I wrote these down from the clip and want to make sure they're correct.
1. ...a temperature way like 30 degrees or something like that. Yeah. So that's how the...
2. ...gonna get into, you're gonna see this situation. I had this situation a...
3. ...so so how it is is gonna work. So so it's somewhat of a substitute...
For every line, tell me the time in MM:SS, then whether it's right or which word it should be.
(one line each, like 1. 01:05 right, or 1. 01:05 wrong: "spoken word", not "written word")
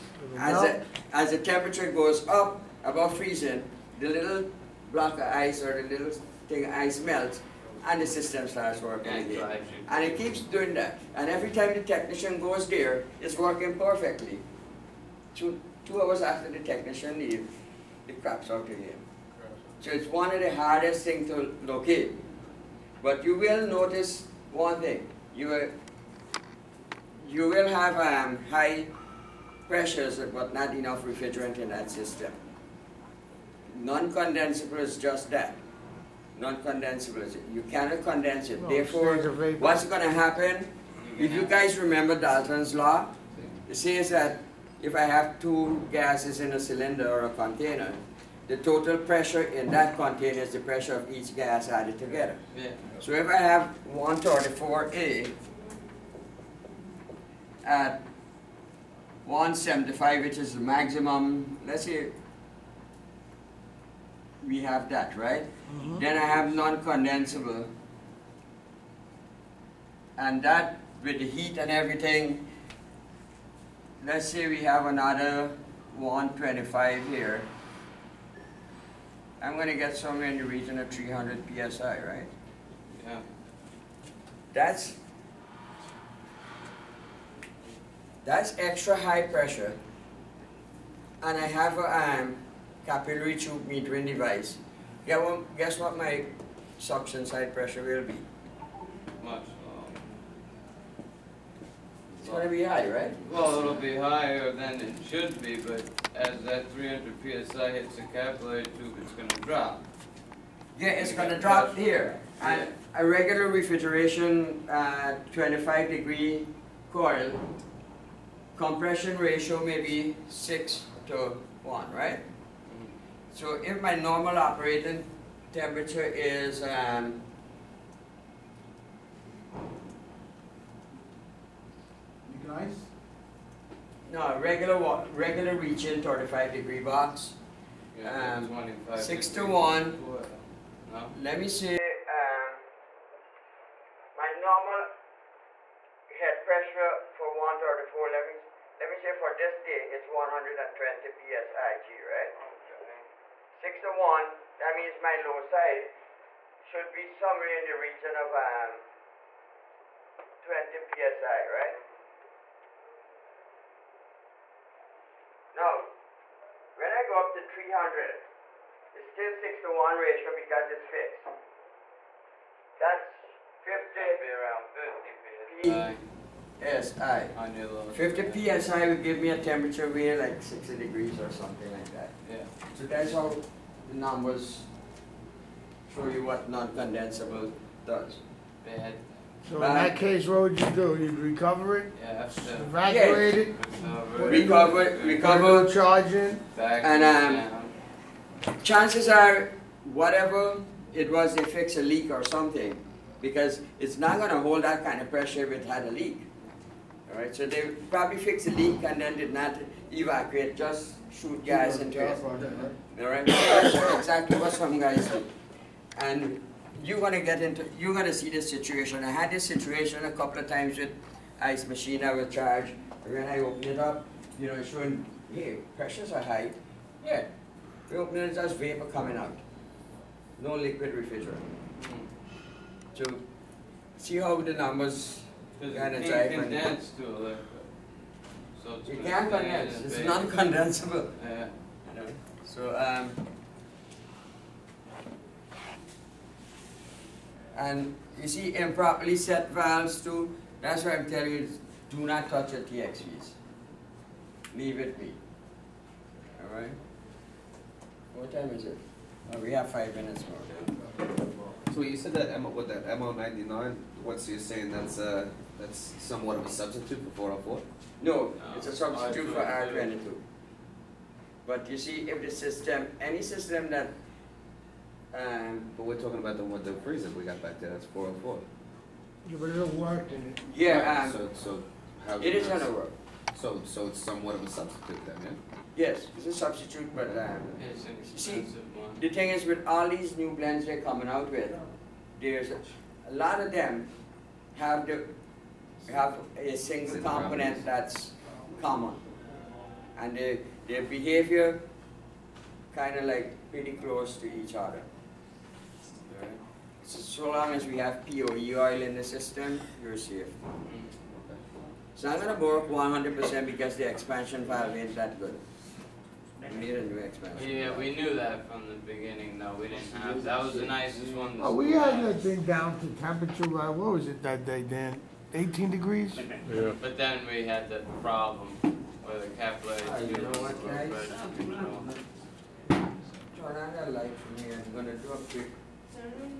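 1. 02:59 wrong: "60", not "30"
2. 03:36 right
3. 04:41 right.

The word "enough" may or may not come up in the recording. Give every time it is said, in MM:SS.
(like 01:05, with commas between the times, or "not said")
00:30.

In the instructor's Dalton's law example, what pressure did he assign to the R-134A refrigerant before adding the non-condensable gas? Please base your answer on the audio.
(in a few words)
175.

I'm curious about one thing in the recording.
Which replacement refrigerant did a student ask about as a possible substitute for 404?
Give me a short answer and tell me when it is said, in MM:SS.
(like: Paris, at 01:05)
MO99, at 04:22.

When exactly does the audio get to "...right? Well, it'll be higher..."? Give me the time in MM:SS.
01:42.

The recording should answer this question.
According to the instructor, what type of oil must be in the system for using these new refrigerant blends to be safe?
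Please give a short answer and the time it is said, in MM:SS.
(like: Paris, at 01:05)
POE oil, at 05:08.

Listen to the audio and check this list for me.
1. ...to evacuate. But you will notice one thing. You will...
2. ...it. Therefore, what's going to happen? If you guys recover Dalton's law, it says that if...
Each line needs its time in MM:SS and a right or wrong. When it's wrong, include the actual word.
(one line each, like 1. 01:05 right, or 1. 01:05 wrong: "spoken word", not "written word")
1. 00:21 wrong: "locate", not "evacuate"
2. 00:38 wrong: "remember", not "recover".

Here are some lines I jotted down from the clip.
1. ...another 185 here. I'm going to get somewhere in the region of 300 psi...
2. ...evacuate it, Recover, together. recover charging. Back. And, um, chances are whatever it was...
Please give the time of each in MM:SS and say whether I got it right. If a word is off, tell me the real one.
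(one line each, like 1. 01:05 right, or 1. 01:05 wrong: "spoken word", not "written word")
1. 01:14 wrong: "125", not "185"
2. 03:12 wrong: "recover", not "together".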